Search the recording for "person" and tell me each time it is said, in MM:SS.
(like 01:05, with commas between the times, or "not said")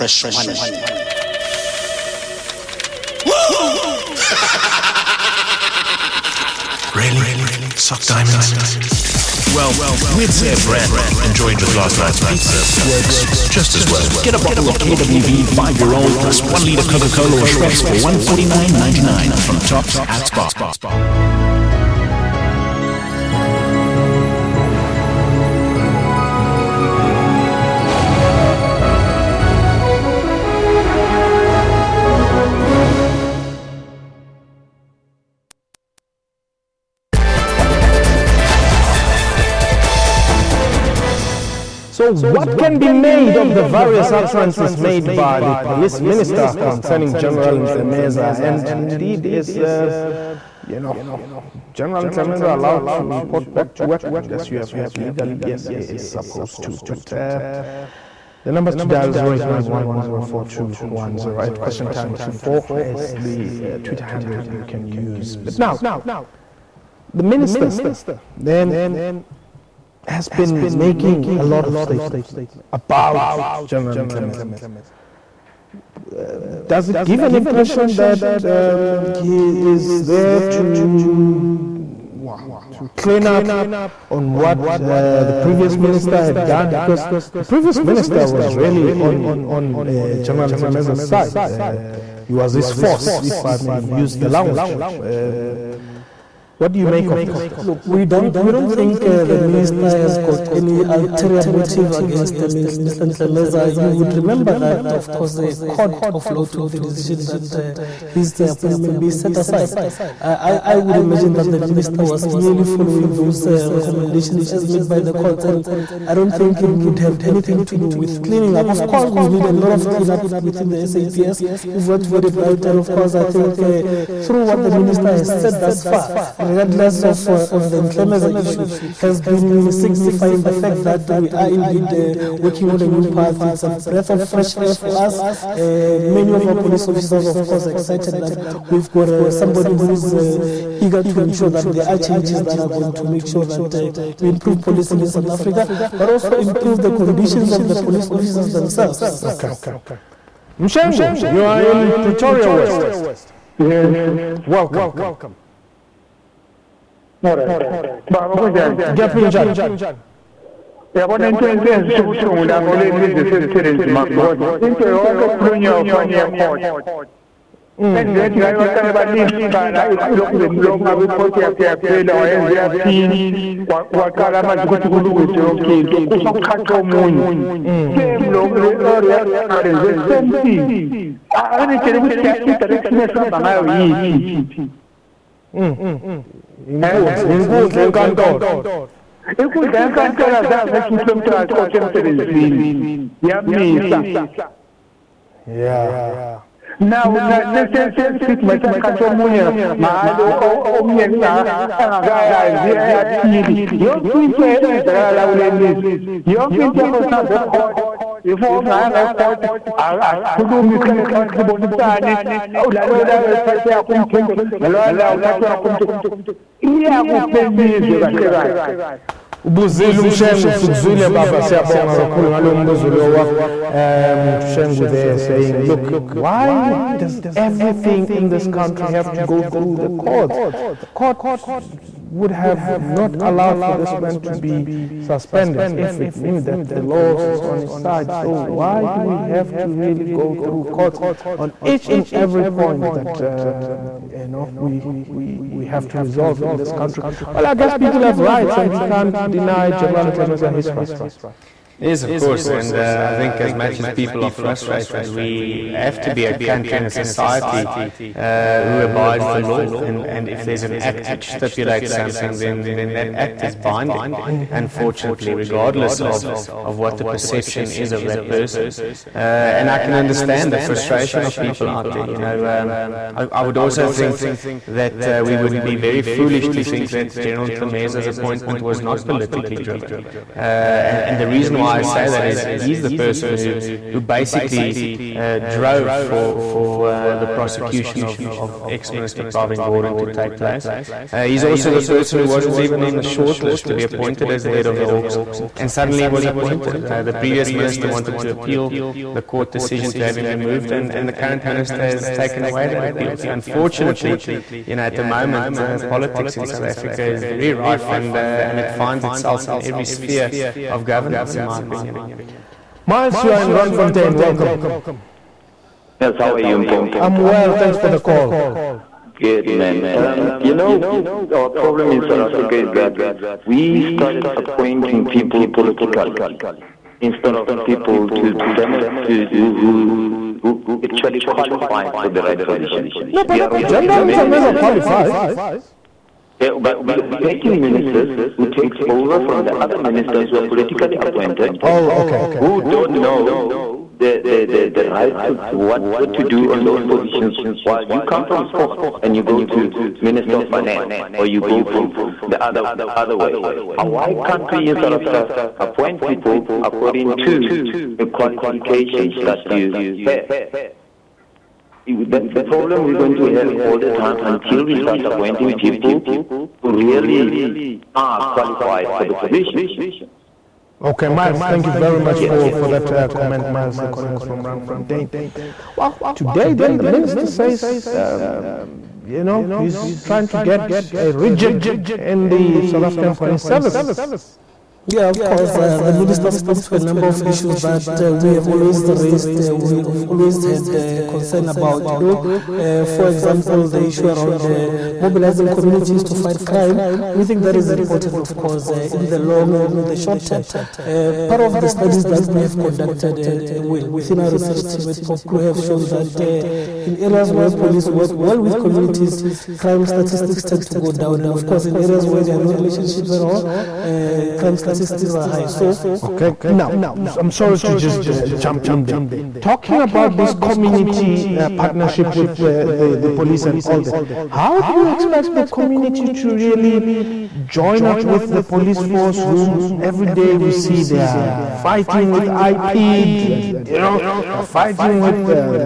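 04:28, 04:42, 04:51.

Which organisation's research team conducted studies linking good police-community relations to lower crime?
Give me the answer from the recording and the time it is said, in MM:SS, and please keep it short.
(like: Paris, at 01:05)
POPCRU, at 06:45.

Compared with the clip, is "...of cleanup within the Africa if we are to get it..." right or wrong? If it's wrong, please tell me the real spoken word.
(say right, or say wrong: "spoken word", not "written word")
wrong: "SAPS", not "Africa".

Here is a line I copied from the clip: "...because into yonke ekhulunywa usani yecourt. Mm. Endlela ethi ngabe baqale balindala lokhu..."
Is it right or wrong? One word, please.
right.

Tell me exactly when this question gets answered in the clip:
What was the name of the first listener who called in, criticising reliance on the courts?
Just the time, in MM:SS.
02:30.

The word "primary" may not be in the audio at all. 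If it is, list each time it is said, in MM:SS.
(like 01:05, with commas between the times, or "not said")
not said.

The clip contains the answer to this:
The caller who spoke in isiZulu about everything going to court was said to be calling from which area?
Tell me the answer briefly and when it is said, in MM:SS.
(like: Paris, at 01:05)
Pretoria West, at 02:31.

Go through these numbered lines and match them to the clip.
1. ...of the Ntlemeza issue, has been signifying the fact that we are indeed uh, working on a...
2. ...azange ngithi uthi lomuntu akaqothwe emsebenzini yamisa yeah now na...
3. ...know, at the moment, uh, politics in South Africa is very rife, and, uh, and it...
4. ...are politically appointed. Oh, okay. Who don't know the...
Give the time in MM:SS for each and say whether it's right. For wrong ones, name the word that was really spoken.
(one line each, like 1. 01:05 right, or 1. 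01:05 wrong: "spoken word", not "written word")
1. 02:07 right
2. 03:10 right
3. 05:04 right
4. 05:40 right.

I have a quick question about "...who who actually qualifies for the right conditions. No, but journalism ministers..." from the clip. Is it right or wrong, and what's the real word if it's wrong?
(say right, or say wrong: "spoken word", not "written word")
wrong: "positions", not "conditions".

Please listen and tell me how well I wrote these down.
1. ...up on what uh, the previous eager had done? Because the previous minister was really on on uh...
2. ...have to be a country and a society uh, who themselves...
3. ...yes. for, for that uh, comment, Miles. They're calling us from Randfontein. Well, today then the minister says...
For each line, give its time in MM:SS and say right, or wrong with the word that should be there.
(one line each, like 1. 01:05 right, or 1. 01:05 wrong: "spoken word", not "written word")
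1. 01:23 wrong: "minister", not "eager"
2. 04:15 wrong: "abides", not "themselves"
3. 06:12 right.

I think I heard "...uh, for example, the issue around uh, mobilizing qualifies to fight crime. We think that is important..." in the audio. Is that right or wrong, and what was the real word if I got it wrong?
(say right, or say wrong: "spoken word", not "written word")
wrong: "communities", not "qualifies".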